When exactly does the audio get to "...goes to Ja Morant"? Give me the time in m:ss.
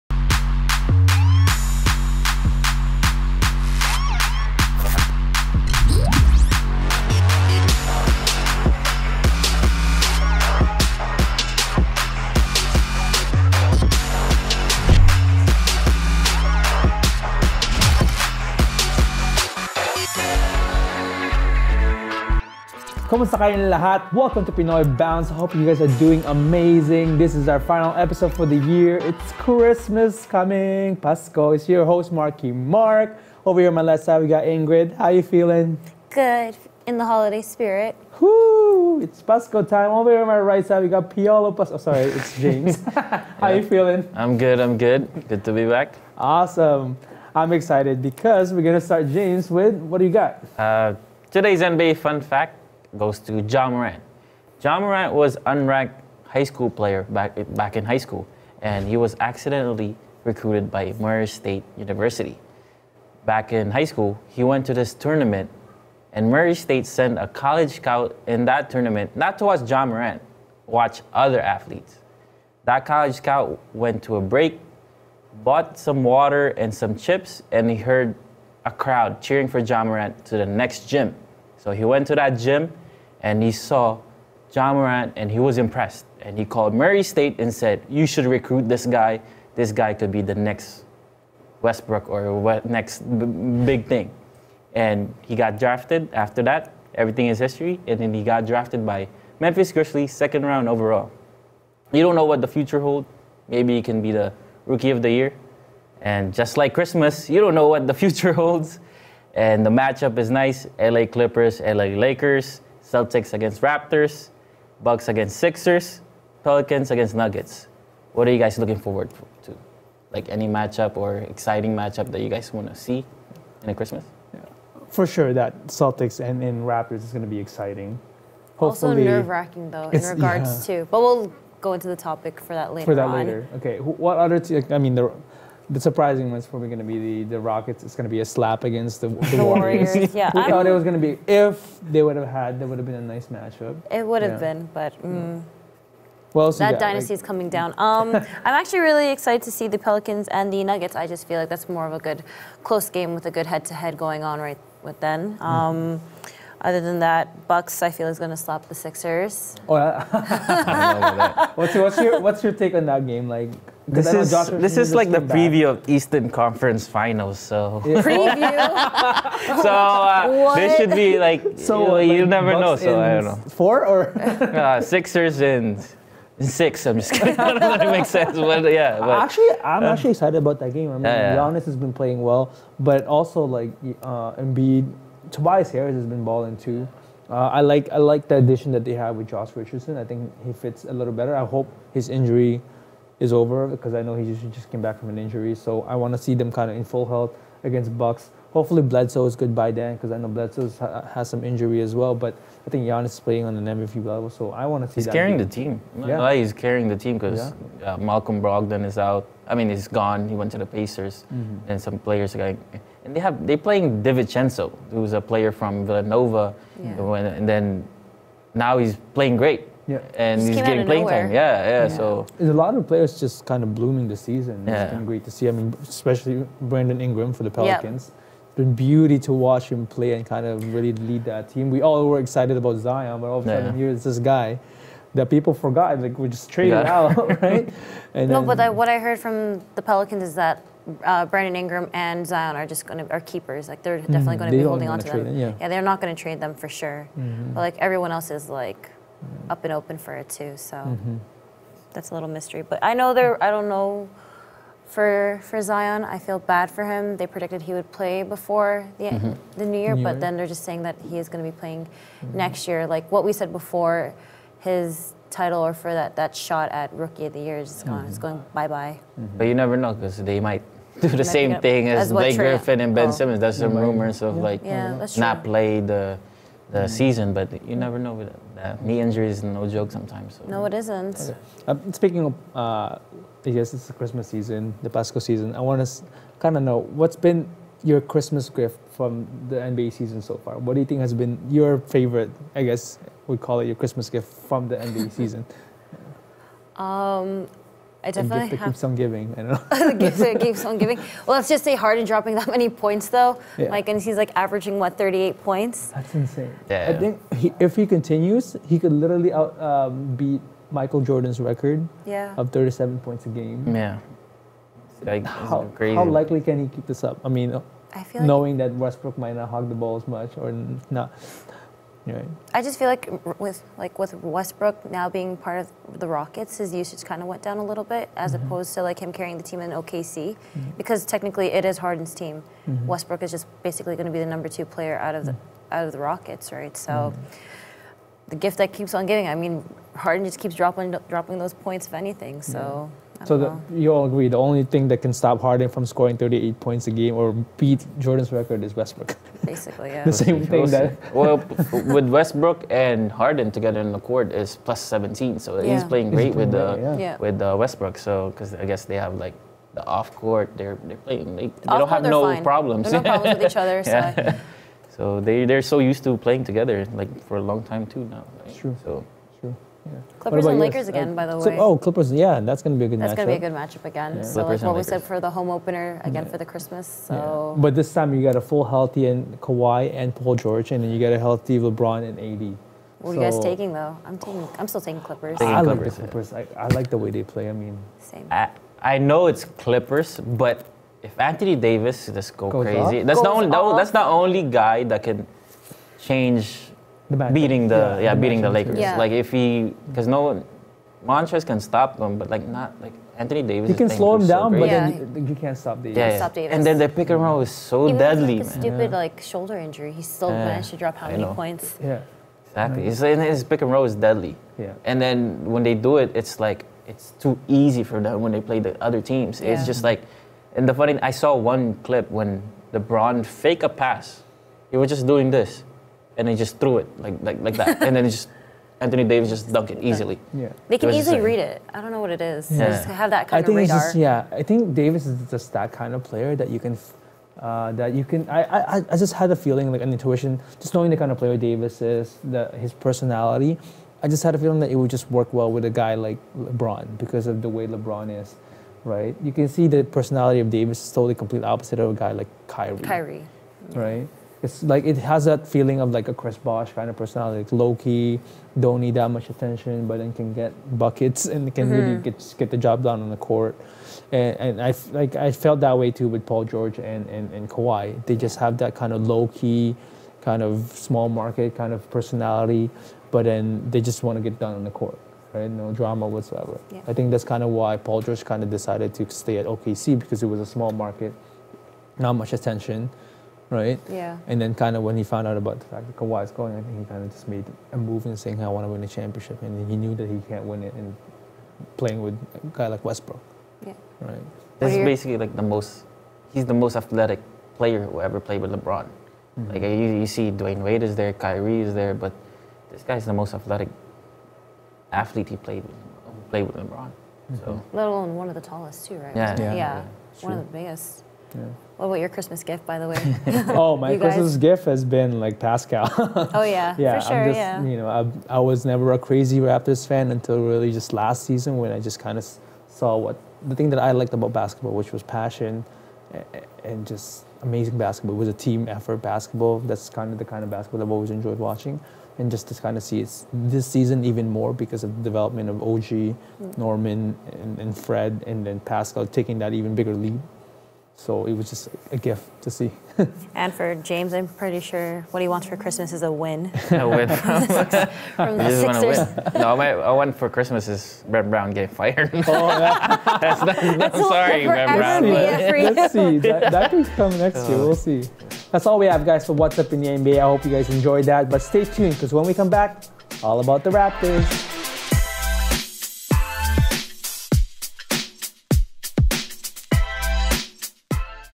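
0:52.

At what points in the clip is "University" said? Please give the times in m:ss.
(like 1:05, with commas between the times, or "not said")
1:01.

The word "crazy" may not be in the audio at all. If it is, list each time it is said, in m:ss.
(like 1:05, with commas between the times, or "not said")
6:32, 8:38.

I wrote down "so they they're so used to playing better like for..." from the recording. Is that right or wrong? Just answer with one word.
wrong.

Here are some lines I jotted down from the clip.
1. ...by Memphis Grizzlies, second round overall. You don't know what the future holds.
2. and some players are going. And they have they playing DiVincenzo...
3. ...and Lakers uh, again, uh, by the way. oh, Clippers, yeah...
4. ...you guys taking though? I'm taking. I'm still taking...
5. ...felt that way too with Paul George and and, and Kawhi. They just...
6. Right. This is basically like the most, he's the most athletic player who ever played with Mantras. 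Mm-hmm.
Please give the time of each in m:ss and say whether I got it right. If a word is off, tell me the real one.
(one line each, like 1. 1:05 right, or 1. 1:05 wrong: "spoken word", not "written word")
1. 1:38 right
2. 3:31 right
3. 6:10 right
4. 6:23 right
5. 7:45 right
6. 8:13 wrong: "LeBron", not "Mantras".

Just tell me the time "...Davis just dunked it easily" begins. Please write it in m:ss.
7:09.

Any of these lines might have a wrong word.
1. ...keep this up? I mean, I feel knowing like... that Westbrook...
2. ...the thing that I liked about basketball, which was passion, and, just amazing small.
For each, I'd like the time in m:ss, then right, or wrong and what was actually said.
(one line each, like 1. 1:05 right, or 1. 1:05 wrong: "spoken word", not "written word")
1. 5:16 right
2. 8:43 wrong: "basketball", not "small".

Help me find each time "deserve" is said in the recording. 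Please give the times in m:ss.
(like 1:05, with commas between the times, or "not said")
not said.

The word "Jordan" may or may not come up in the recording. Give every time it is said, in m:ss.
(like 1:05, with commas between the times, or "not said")
5:11, 5:47.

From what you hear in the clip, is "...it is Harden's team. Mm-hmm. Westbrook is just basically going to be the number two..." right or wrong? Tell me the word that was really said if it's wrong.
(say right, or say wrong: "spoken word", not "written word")
right.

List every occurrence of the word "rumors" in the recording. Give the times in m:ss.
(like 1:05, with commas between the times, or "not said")
4:33.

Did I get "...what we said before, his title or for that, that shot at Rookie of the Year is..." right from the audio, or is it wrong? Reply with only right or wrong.
right.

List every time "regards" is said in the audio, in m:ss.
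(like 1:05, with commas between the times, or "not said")
2:10.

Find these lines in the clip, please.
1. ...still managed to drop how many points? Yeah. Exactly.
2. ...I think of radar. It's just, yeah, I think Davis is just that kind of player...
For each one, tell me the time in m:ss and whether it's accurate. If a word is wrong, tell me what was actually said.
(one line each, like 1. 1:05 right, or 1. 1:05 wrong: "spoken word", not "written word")
1. 6:50 right
2. 7:13 right.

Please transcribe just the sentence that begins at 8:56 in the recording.
Norman, and, and Fred, and then Pascal taking that even bigger leap so it was just a gift to see.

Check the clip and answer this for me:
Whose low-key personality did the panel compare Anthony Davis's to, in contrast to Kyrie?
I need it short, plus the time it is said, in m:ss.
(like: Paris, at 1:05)
Chris Bosh, at 7:36.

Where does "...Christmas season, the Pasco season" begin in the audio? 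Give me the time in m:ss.
4:43.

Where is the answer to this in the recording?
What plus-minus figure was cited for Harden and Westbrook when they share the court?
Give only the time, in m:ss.
5:54.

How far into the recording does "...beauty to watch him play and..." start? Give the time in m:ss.
3:48.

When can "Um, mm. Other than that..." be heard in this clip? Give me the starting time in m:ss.
2:35.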